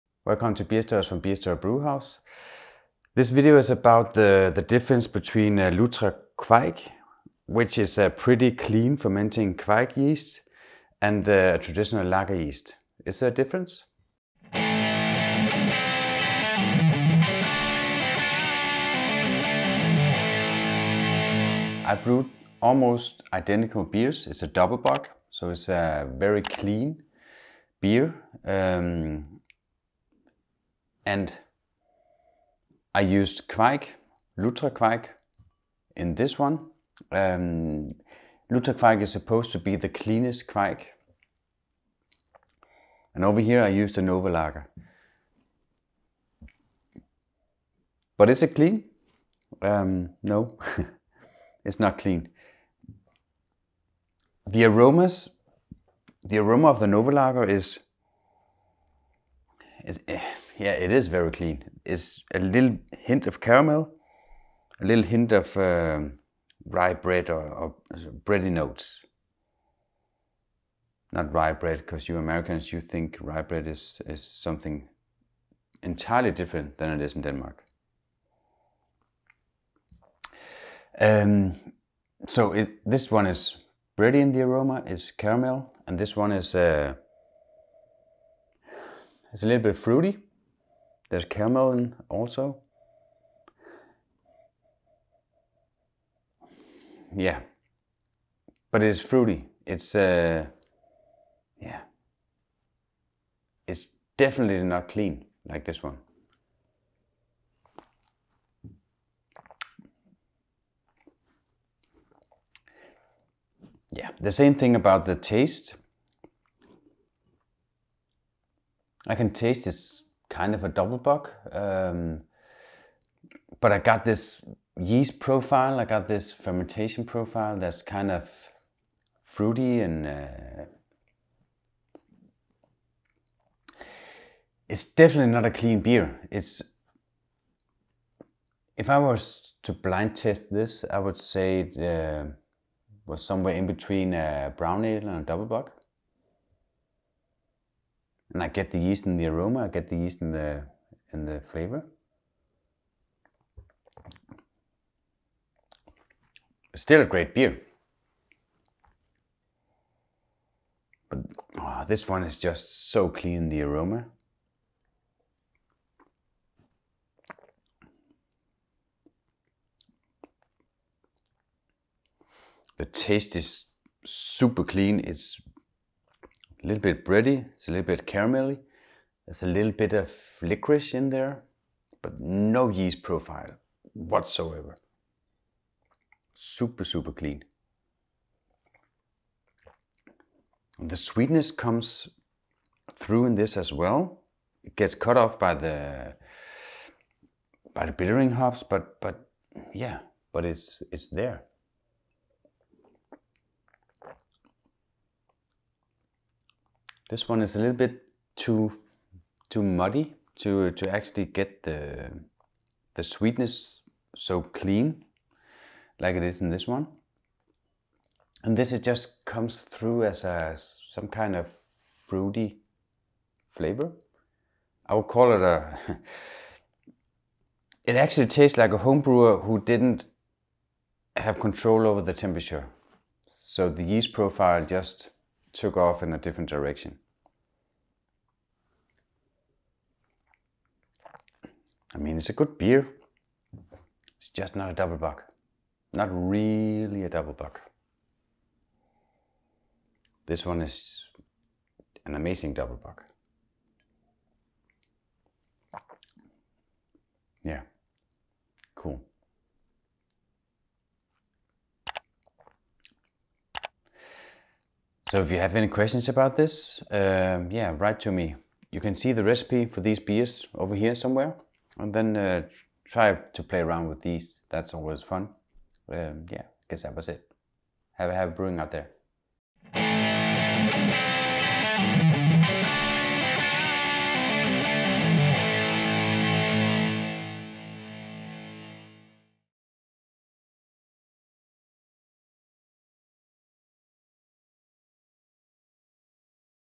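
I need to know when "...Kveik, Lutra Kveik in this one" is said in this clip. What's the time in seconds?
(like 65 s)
33 s.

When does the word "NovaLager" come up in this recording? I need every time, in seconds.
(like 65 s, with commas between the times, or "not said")
44 s, 56 s.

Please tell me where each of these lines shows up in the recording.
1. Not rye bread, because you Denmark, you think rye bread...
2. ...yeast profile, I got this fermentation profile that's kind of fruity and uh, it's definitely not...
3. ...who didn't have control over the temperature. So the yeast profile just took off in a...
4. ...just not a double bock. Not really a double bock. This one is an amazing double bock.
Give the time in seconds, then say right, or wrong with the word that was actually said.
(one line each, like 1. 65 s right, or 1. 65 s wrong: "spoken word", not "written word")
1. 71 s wrong: "Americans", not "Denmark"
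2. 124 s right
3. 229 s right
4. 244 s right.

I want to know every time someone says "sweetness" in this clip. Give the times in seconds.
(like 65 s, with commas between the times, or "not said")
190 s, 213 s.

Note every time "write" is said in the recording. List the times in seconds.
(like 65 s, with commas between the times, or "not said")
267 s.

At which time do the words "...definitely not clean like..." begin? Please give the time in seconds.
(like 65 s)
104 s.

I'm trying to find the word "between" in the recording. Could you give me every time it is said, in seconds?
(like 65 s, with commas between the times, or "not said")
5 s, 143 s.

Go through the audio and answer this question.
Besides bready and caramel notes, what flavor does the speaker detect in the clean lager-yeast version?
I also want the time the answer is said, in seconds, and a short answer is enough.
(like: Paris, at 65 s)
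Licorice, at 180 s.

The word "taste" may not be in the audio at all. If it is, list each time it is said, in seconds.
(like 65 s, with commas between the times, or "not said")
115 s, 119 s, 172 s, 228 s.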